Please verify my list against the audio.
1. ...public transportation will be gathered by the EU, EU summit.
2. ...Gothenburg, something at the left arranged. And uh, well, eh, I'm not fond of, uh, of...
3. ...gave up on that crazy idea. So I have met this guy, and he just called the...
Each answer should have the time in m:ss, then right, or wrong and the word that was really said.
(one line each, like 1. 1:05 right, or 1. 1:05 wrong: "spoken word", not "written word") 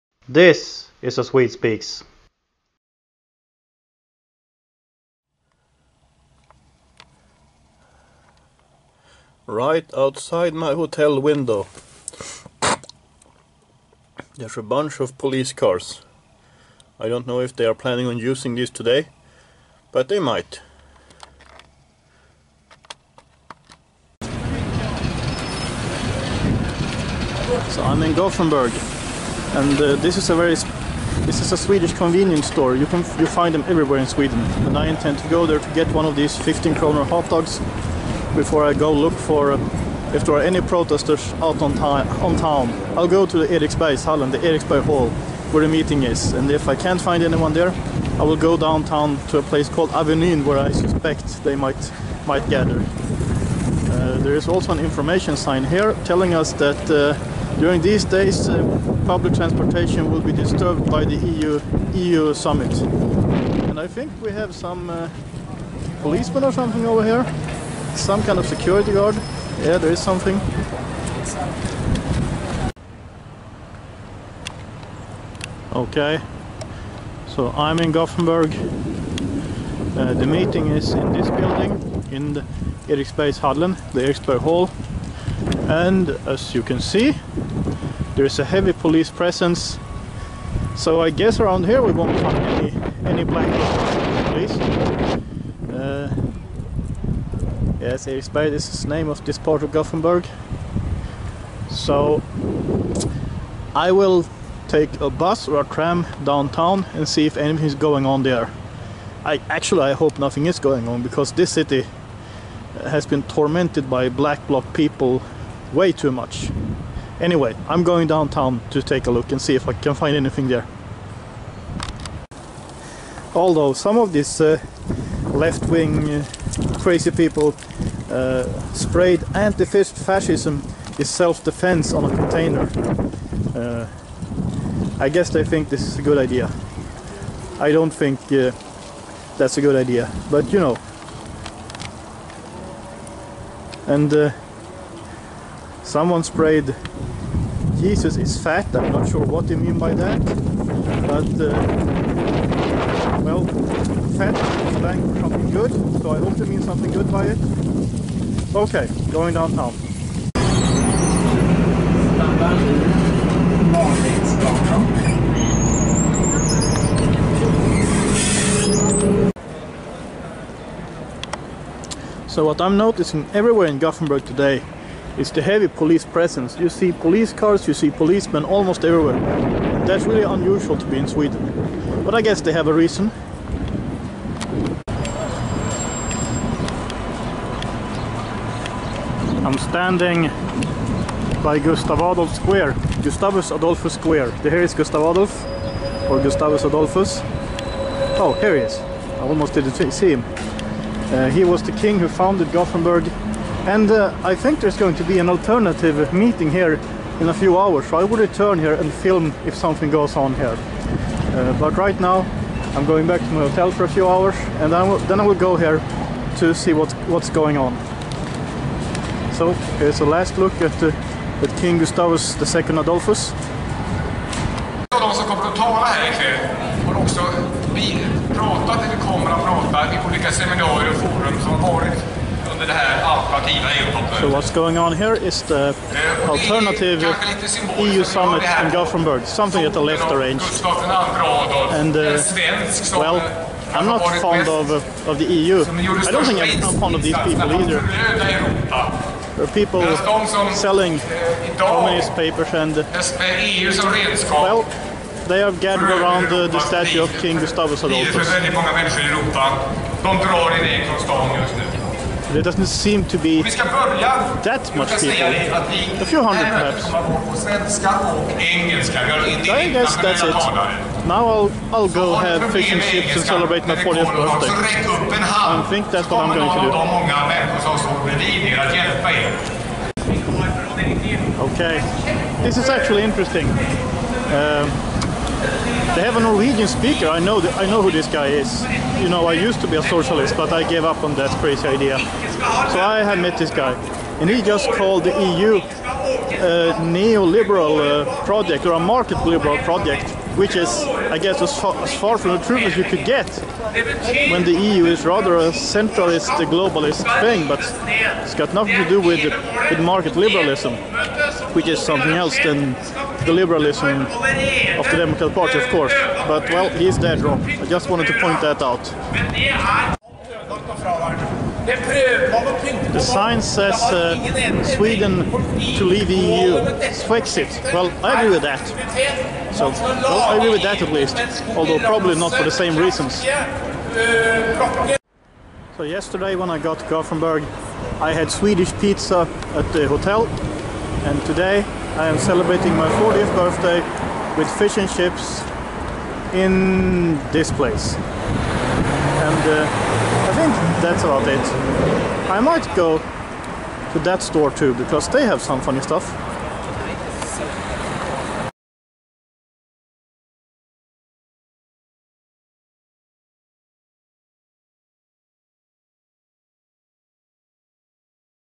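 1. 0:59 wrong: "disturbed", not "gathered"
2. 3:58 right
3. 4:50 right.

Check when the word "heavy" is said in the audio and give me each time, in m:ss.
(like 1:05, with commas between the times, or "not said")
1:28, 2:55.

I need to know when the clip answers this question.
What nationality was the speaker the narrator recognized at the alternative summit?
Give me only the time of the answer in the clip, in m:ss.
4:46.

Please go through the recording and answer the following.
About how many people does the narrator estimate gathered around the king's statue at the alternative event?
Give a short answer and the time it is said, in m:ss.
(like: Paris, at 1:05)
A few hundred, at 4:26.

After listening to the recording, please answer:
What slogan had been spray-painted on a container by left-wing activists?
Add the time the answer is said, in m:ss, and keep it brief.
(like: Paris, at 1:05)
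Anti-fascism is self-defense, at 2:09.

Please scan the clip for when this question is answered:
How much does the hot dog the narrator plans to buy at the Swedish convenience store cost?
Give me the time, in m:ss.
0:36.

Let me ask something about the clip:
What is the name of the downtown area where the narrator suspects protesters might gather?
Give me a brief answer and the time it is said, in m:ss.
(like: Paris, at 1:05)
Avenyn, at 0:49.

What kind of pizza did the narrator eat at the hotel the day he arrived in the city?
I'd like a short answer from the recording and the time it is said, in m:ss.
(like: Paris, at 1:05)
Swedish pizza, at 5:38.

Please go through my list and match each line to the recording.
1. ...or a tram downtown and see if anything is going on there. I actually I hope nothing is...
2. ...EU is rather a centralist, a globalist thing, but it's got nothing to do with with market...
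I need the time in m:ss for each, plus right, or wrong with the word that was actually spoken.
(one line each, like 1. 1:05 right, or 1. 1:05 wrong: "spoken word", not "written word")
1. 1:45 right
2. 5:04 right.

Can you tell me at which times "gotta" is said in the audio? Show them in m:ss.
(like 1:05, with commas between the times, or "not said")
not said.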